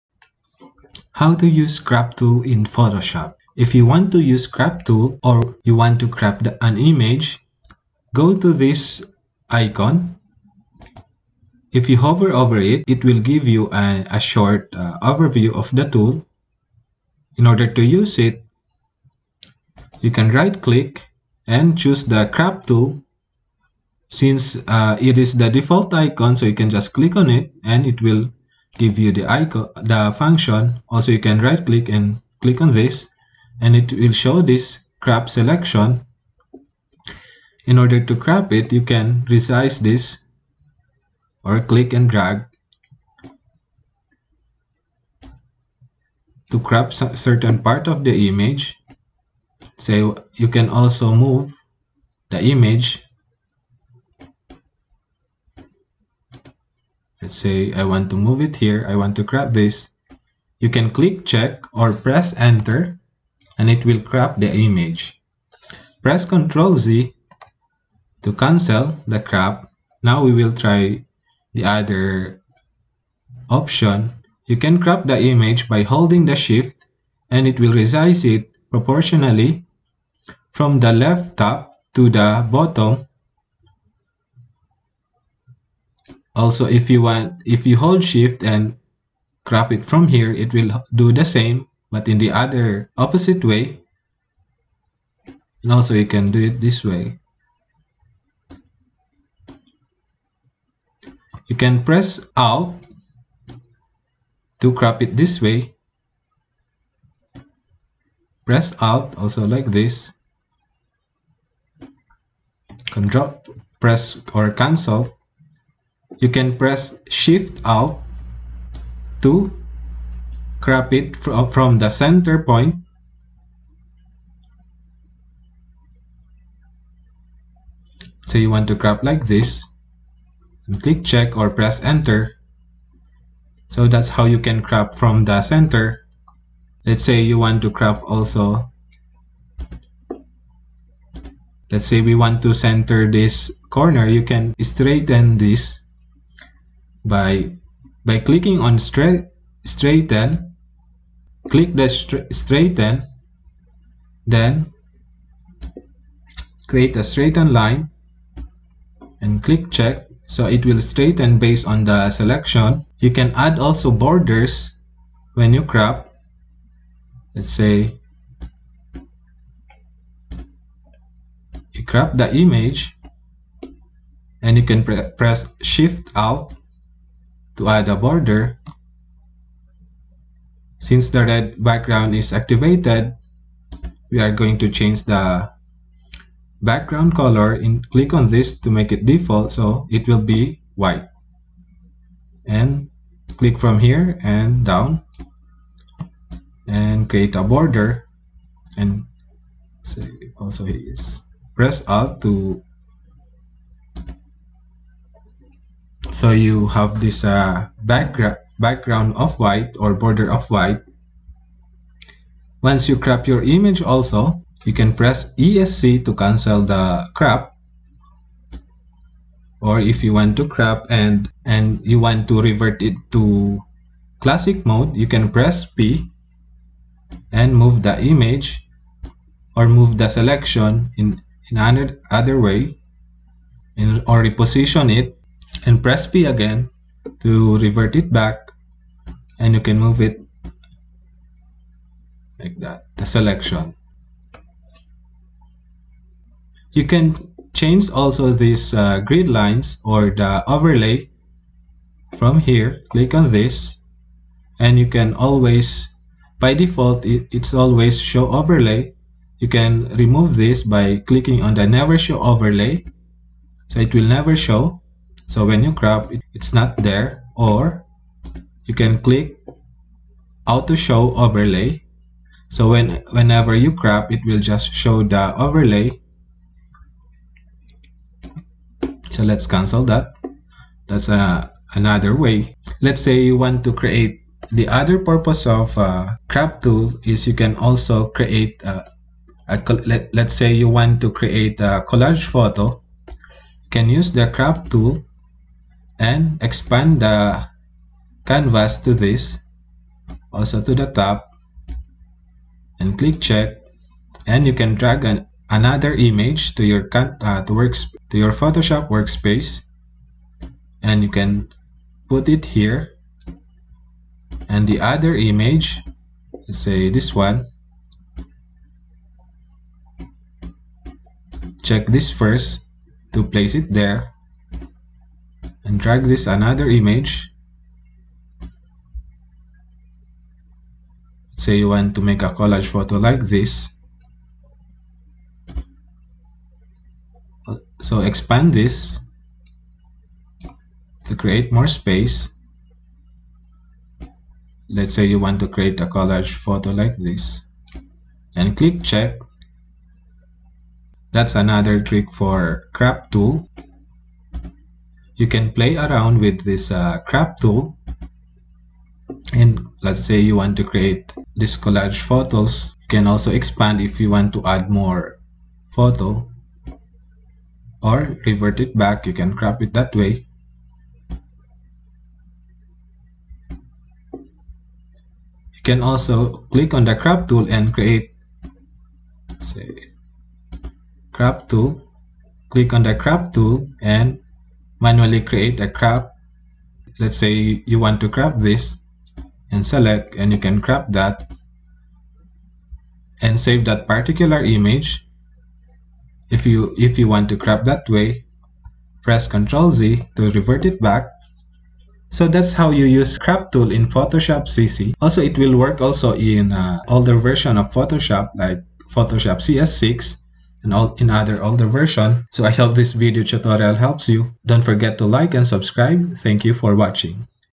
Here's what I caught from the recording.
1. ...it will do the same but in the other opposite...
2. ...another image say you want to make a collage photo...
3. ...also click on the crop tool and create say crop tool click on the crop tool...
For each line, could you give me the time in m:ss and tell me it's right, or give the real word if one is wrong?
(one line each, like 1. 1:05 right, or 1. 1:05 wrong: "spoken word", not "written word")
1. 1:30 right
2. 5:26 right
3. 6:15 right.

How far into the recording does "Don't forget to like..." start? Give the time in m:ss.
6:54.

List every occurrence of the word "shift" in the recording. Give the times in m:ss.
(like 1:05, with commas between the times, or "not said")
1:16, 1:28, 1:57, 2:55.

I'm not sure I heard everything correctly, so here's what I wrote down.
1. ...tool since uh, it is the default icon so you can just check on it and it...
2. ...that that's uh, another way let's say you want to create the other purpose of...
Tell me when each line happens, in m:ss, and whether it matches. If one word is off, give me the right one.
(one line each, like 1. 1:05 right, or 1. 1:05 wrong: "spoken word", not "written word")
1. 0:22 wrong: "click", not "check"
2. 4:39 right.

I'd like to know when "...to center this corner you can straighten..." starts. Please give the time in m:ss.
2:22.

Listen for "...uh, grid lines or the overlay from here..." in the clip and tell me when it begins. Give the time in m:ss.
4:08.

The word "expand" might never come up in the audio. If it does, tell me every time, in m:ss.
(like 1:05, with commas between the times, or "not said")
4:56, 5:38, 6:03.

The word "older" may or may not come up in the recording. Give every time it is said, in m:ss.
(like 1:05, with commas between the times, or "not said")
6:46, 6:51.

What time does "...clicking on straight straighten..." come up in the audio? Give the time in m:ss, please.
2:28.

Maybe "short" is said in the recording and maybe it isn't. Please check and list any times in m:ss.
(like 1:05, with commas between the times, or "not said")
0:14.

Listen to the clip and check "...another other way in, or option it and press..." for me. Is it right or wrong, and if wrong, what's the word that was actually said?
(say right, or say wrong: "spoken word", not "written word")
wrong: "reposition", not "option".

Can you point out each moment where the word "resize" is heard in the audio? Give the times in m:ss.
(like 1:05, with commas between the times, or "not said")
0:39, 1:17.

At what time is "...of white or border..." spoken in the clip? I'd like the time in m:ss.
3:29.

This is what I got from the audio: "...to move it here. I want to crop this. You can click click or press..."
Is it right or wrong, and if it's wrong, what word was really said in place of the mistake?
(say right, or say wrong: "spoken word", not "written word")
wrong: "check", not "click".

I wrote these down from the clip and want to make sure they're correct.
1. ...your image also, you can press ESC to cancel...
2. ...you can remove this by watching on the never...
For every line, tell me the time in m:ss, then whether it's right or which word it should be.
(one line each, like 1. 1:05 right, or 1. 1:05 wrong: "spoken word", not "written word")
1. 3:33 right
2. 4:19 wrong: "clicking", not "watching".